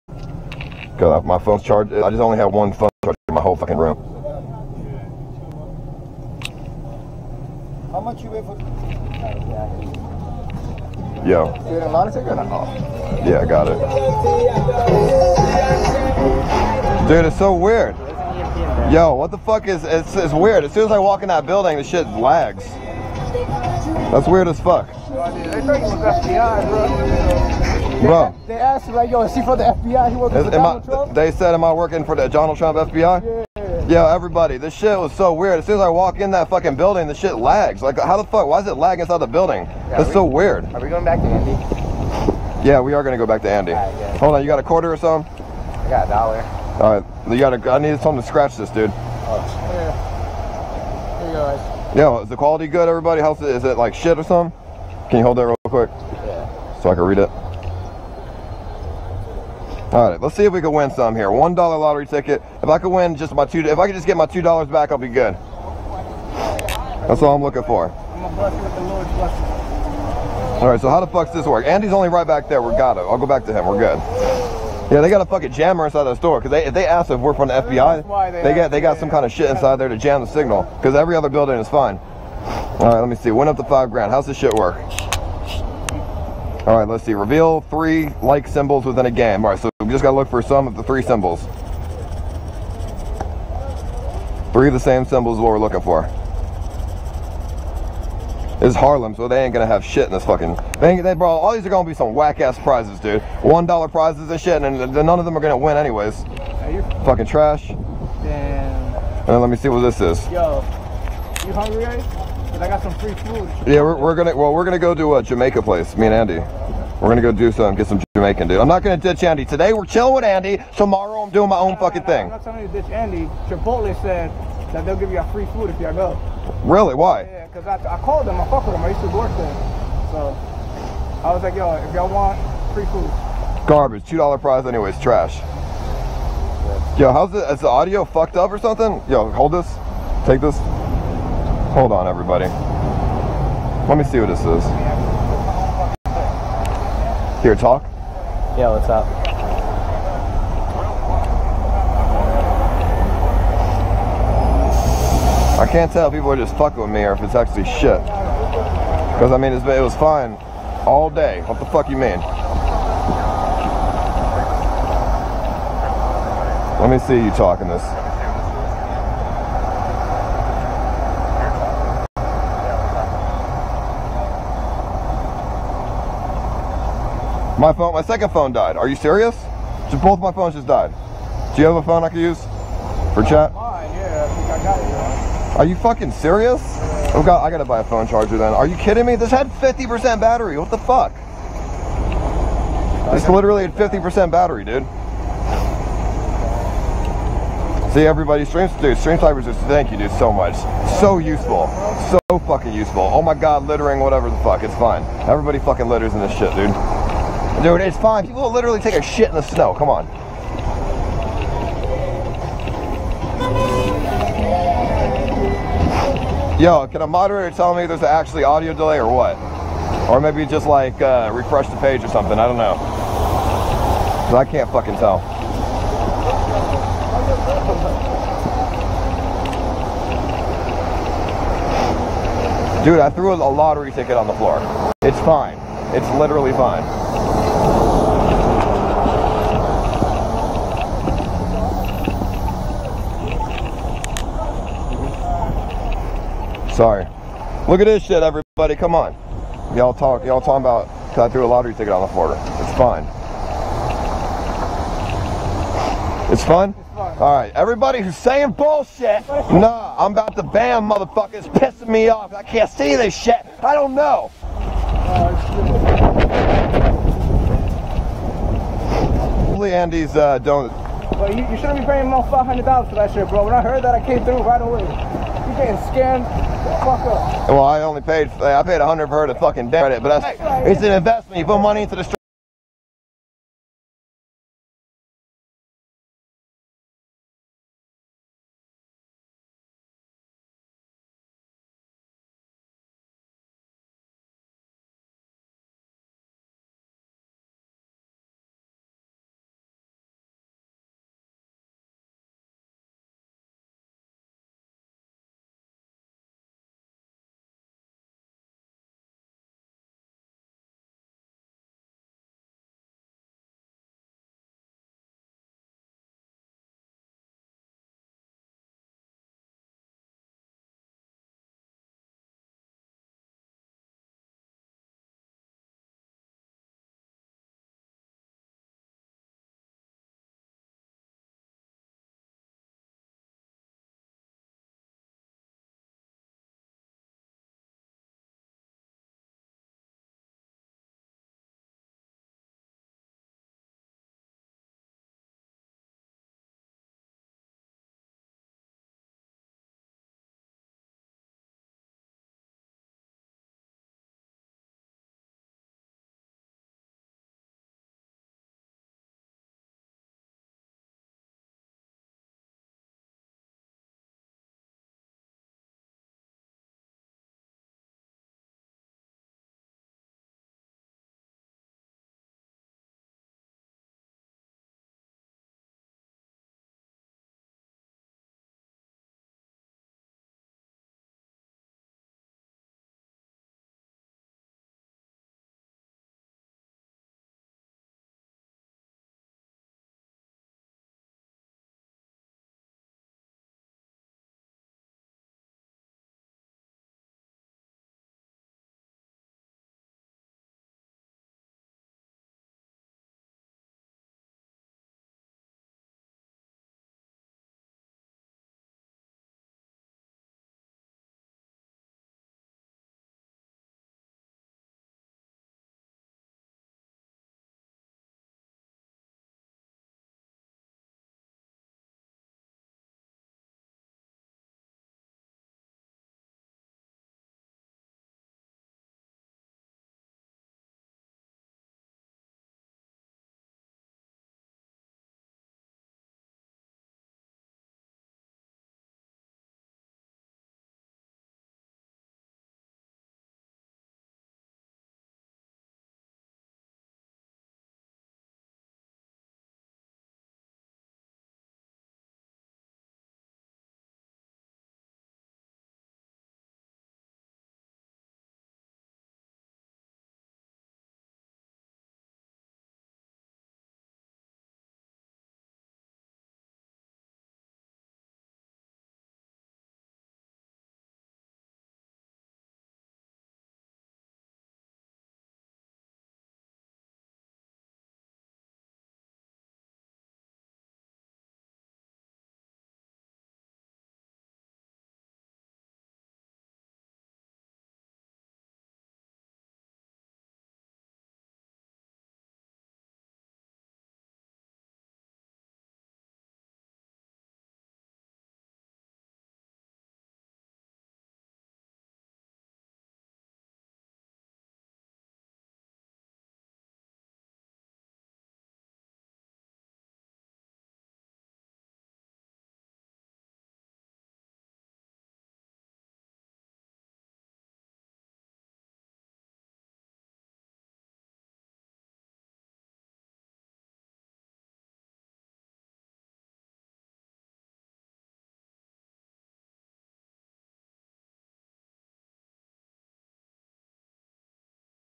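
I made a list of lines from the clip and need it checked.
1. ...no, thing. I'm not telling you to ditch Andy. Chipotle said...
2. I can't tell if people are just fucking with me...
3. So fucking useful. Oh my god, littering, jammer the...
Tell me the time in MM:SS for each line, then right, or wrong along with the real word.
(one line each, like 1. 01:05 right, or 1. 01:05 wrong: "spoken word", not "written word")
1. 02:02 right
2. 02:35 right
3. 03:22 wrong: "whatever", not "jammer".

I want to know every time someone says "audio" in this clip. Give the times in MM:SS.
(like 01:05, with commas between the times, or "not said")
02:17, 03:38.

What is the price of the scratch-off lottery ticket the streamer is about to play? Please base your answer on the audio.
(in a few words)
$1.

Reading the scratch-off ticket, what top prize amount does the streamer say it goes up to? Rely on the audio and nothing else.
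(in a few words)
5 grand.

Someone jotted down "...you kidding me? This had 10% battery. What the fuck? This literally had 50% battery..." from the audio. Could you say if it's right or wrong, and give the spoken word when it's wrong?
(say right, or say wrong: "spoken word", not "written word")
wrong: "50", not "10".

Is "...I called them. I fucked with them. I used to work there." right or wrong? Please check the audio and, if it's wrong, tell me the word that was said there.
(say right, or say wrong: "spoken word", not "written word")
right.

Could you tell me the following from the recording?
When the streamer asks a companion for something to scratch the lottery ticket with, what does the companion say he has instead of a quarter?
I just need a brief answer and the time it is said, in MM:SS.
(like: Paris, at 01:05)
a dollar, at 00:45.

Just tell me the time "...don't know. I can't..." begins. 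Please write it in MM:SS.
03:42.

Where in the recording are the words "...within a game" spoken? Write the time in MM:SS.
01:28.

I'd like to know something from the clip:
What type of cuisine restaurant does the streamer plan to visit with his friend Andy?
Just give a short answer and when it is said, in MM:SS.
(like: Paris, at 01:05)
Jamaican, at 01:55.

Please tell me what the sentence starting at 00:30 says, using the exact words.
He working is, for Donald I, Trump?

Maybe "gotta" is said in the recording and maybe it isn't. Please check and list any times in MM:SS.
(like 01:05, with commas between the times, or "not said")
01:30, 03:07.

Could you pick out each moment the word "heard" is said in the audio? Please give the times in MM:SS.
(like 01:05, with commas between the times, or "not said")
04:33.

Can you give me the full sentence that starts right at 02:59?
So both my phones just died.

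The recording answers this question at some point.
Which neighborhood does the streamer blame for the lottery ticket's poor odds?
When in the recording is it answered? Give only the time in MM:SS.
01:38.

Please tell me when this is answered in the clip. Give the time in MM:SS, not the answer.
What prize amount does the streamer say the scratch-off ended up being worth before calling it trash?
02:14.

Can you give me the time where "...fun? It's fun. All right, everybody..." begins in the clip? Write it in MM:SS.
04:16.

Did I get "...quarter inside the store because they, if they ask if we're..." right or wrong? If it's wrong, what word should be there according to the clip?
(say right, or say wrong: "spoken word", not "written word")
wrong: "jammer", not "quarter".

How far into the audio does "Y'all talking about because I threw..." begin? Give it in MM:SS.
04:10.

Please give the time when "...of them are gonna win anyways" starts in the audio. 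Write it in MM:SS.
01:45.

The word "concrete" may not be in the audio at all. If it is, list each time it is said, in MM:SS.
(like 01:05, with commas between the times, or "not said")
not said.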